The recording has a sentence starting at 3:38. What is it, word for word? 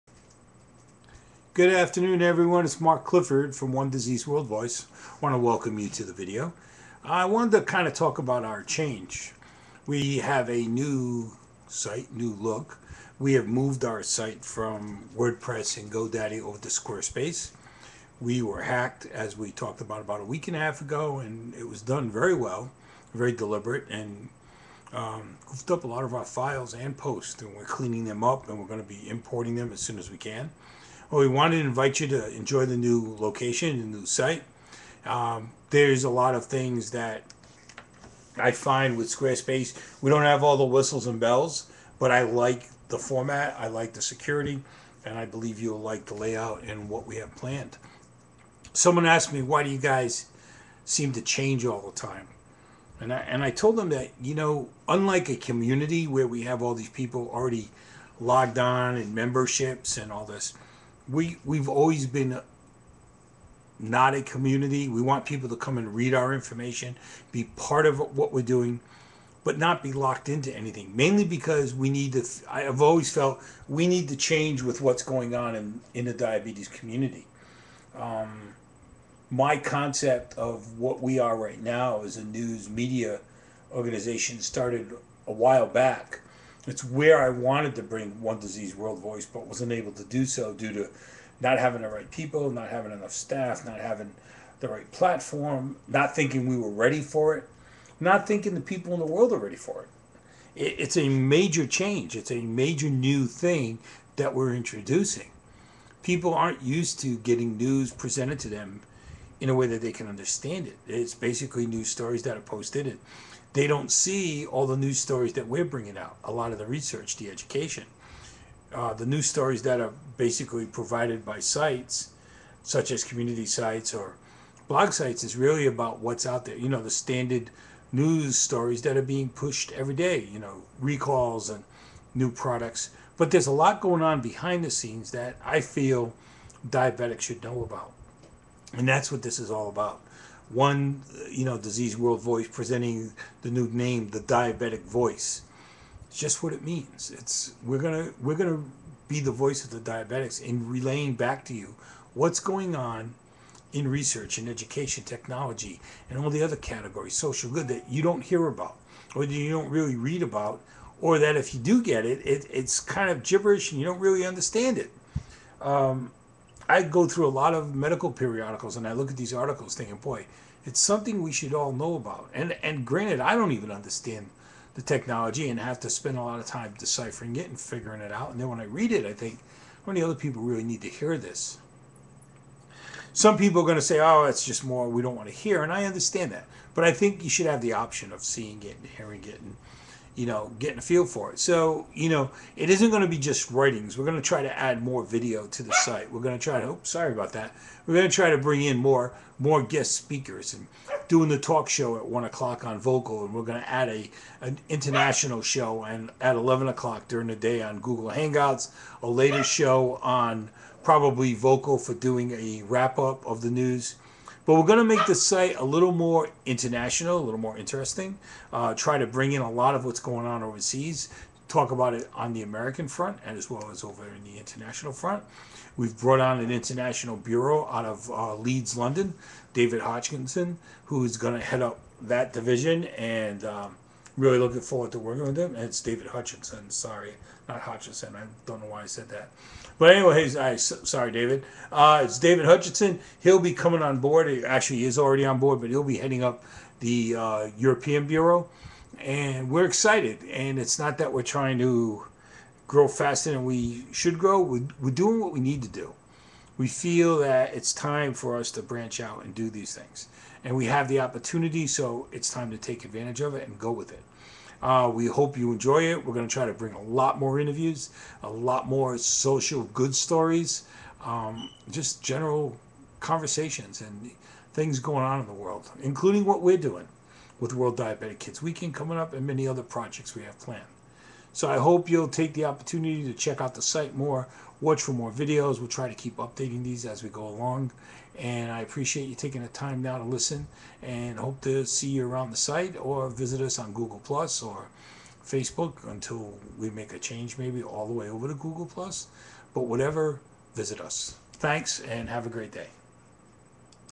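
Uh, try to bring in a lot of what's going on overseas.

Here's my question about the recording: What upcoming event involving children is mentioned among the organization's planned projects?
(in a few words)
World Diabetic Kids Weekend.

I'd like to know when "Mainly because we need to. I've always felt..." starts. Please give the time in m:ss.
1:10.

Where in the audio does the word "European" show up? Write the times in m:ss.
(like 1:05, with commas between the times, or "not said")
4:07.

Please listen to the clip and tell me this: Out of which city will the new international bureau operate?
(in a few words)
Leeds.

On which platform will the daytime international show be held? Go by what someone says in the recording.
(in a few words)
Google Hangouts.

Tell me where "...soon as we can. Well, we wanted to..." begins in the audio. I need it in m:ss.
0:29.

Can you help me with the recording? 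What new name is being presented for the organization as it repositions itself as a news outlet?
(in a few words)
The Diabetic Voice.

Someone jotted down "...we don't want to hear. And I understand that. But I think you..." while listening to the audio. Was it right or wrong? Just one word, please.
right.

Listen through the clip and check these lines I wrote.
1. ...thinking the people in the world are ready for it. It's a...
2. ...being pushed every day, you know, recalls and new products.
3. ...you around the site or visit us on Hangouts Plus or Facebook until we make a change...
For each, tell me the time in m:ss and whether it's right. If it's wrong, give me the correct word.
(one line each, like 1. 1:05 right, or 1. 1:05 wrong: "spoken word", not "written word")
1. 1:38 right
2. 2:09 right
3. 4:51 wrong: "Google", not "Hangouts".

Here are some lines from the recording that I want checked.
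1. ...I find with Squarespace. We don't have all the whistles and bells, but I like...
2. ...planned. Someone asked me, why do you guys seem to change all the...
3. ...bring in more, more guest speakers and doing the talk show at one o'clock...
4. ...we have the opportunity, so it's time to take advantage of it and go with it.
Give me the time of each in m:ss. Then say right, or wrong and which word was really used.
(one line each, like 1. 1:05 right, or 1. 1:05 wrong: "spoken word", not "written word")
1. 0:38 right
2. 0:47 right
3. 3:18 right
4. 4:20 right.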